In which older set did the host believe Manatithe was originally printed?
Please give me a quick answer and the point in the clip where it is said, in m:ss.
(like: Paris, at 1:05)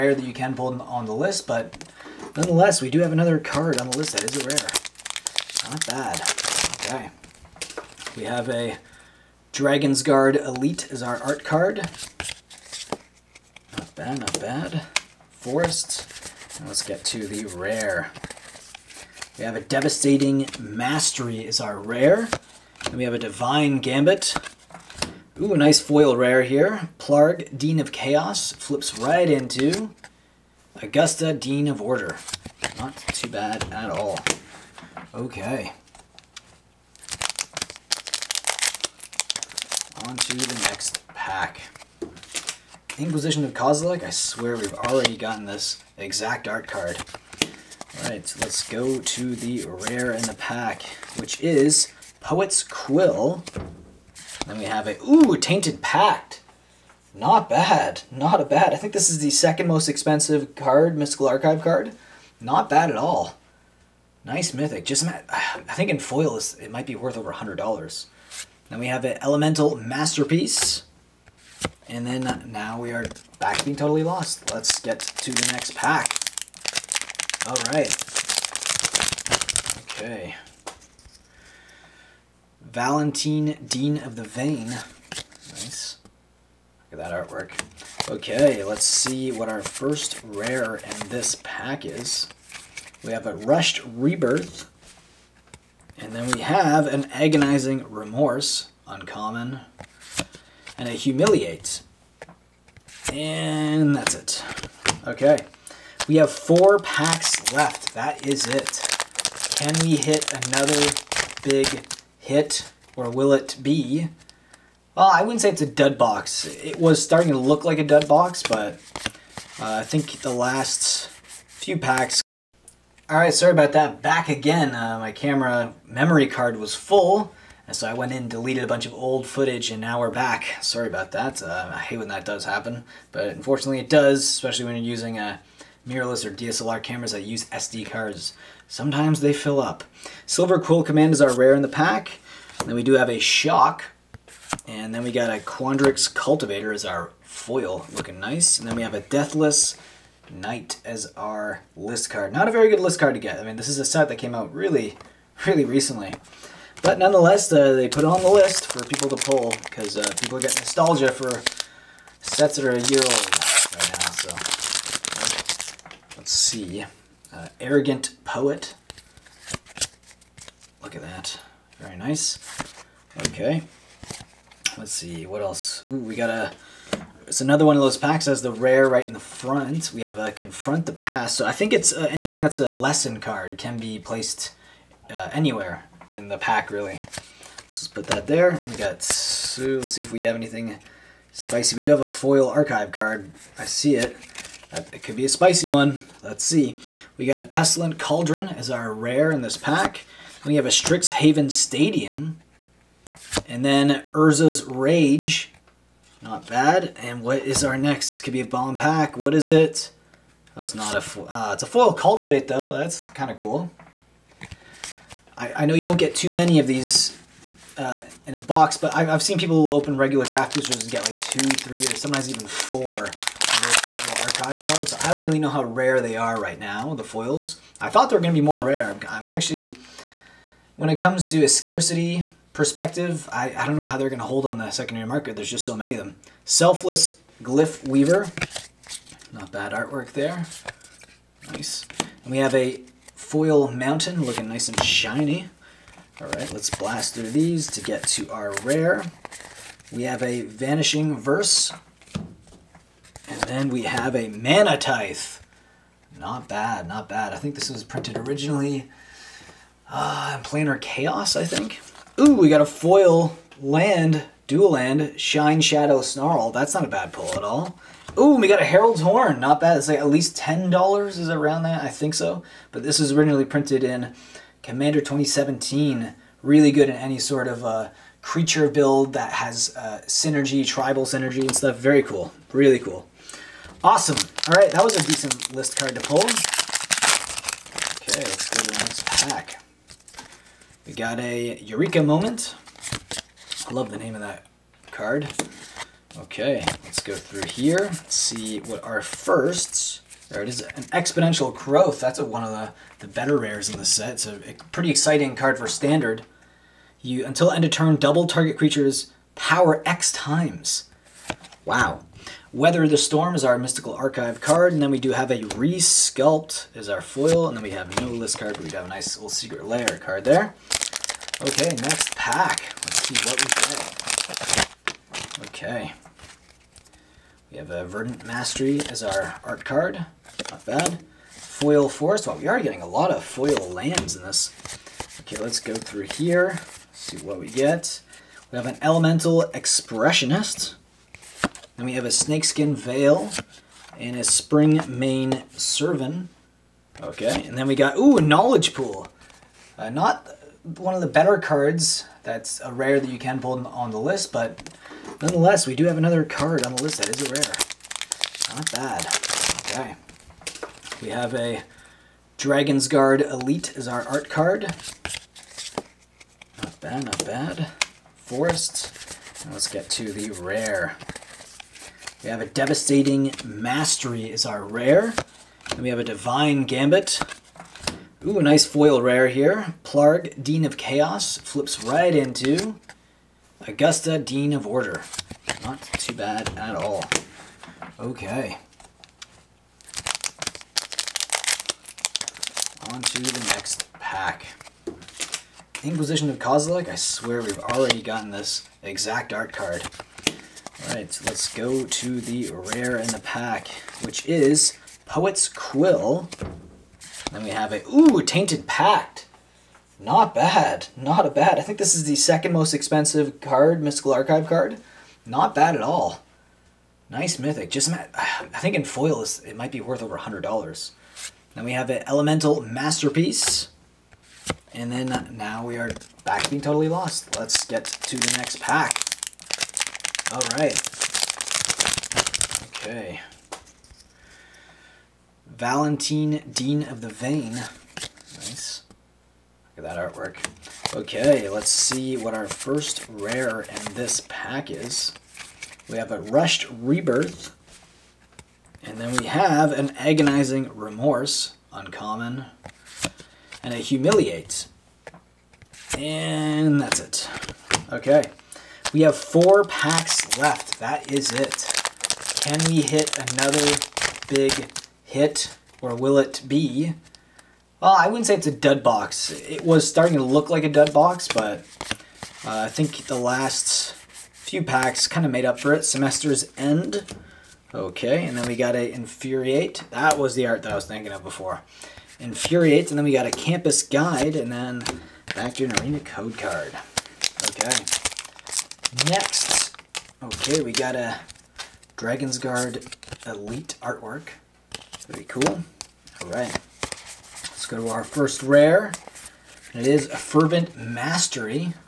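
Planar Chaos, at 4:20.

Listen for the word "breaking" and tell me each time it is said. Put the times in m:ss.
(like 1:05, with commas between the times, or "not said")
not said.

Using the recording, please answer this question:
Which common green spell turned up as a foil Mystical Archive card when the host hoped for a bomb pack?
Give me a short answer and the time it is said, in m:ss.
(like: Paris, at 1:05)
Cultivate, at 3:31.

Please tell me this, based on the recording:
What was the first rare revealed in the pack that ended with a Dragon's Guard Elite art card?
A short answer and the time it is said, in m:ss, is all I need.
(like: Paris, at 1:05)
Fervent Mastery, at 8:20.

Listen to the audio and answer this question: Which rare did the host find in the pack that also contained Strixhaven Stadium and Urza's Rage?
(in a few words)
Pestilent Cauldron.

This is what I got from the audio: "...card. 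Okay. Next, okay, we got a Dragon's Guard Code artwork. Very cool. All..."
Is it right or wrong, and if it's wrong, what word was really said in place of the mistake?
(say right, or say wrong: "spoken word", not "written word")
wrong: "Elite", not "Code".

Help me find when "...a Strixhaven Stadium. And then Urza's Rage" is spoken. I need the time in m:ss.
3:20.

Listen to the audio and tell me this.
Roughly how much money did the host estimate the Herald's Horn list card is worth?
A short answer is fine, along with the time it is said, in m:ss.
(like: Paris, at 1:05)
$10, at 4:30.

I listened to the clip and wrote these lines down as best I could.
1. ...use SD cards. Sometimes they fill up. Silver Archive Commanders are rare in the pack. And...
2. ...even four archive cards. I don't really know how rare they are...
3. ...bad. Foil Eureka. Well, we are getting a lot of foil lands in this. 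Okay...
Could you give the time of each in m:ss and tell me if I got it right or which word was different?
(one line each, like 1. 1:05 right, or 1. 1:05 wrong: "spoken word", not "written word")
1. 2:17 wrong: "Quill", not "Archive"
2. 3:42 right
3. 5:30 wrong: "Forest", not "Eureka".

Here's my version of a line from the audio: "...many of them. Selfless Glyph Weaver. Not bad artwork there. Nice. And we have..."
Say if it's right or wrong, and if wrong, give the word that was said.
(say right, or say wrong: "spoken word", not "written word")
right.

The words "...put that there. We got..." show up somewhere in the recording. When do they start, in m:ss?
3:07.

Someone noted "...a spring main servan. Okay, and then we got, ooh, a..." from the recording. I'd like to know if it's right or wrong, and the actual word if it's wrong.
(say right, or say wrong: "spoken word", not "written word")
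right.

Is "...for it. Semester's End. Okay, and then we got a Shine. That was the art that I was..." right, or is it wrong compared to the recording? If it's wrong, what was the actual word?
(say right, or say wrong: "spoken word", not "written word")
wrong: "Infuriate", not "Shine".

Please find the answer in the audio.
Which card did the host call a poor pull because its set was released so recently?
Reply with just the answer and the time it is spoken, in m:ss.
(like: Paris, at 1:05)
Deathless Knight, at 2:29.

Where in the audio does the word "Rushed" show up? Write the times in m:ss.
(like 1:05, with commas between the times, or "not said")
1:33, 7:26.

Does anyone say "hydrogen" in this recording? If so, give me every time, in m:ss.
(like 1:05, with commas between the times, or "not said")
not said.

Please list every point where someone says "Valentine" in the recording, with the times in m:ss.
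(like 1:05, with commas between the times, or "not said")
1:22, 7:15.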